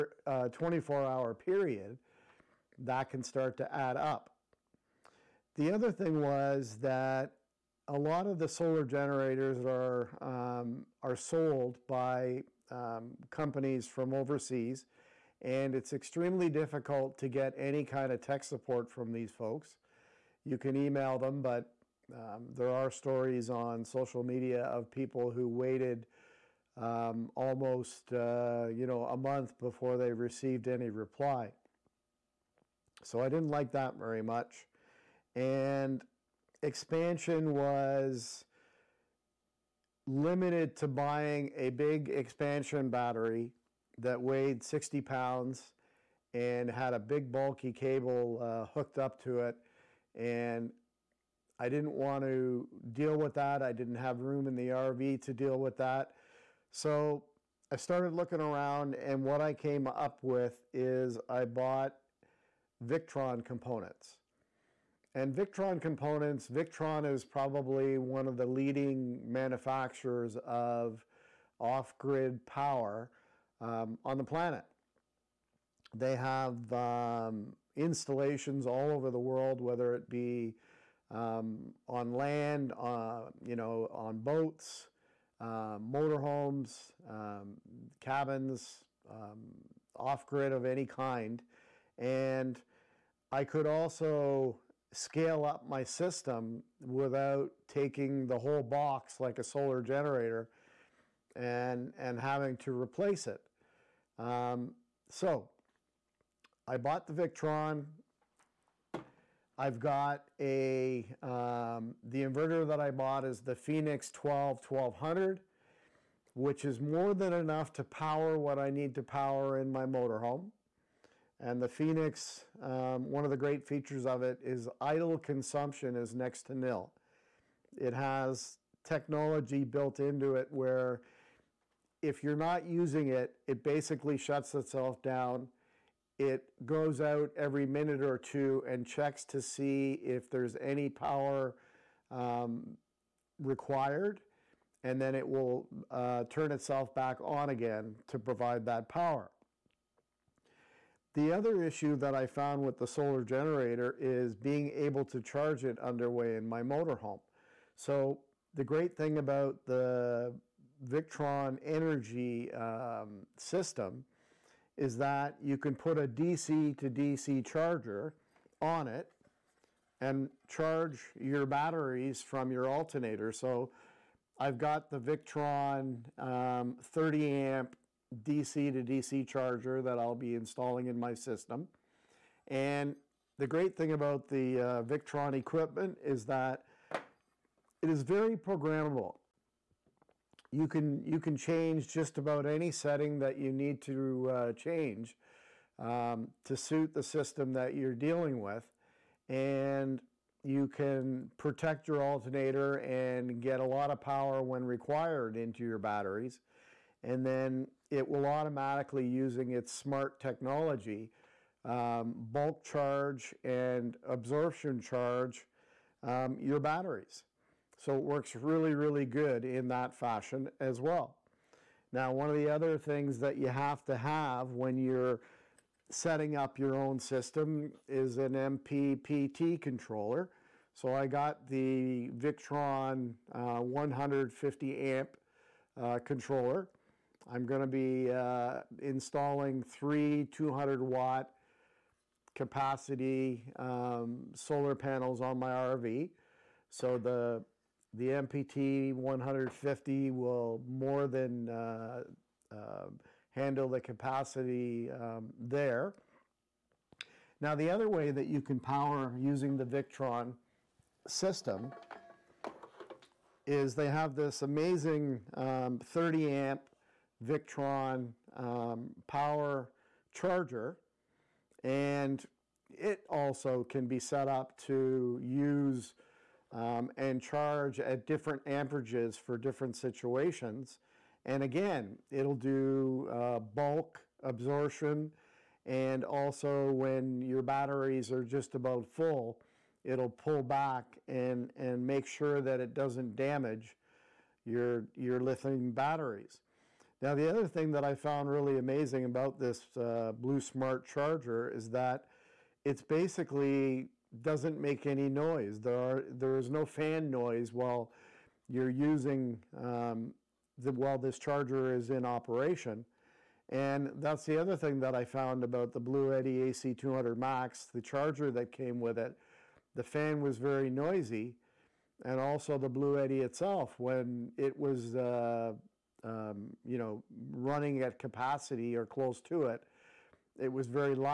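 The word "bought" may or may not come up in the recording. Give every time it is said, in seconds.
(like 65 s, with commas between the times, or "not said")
61 s, 106 s, 112 s.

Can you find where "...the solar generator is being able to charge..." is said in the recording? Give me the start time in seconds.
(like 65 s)
152 s.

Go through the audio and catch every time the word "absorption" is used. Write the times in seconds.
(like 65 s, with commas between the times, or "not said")
214 s, 284 s.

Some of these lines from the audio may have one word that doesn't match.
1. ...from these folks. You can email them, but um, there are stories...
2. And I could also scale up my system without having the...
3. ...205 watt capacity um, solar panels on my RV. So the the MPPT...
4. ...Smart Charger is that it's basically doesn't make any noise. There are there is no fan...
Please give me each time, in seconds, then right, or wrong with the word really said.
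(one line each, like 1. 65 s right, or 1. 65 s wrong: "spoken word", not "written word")
1. 18 s right
2. 91 s wrong: "taking", not "having"
3. 240 s wrong: "200", not "205"
4. 300 s right.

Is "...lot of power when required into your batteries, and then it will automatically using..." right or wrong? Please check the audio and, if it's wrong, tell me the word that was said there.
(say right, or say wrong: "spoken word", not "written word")
right.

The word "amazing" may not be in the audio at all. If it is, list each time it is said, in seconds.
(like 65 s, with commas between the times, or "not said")
264 s, 298 s.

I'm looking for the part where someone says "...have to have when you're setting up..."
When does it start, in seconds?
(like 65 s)
223 s.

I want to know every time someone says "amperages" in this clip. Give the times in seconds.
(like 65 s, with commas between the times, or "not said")
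278 s.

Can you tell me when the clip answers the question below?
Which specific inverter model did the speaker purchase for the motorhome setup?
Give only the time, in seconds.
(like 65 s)
113 s.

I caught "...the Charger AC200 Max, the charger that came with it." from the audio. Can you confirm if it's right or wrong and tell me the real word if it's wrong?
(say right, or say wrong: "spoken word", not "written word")
wrong: "Bluetti", not "Charger".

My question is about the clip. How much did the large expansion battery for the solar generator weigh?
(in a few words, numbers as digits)
60 pounds.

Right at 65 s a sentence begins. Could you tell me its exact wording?
And Victron components, Victron is probably one of the leading manufacturers of off grid power um, on the planet.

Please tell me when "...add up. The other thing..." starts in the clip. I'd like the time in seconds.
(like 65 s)
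3 s.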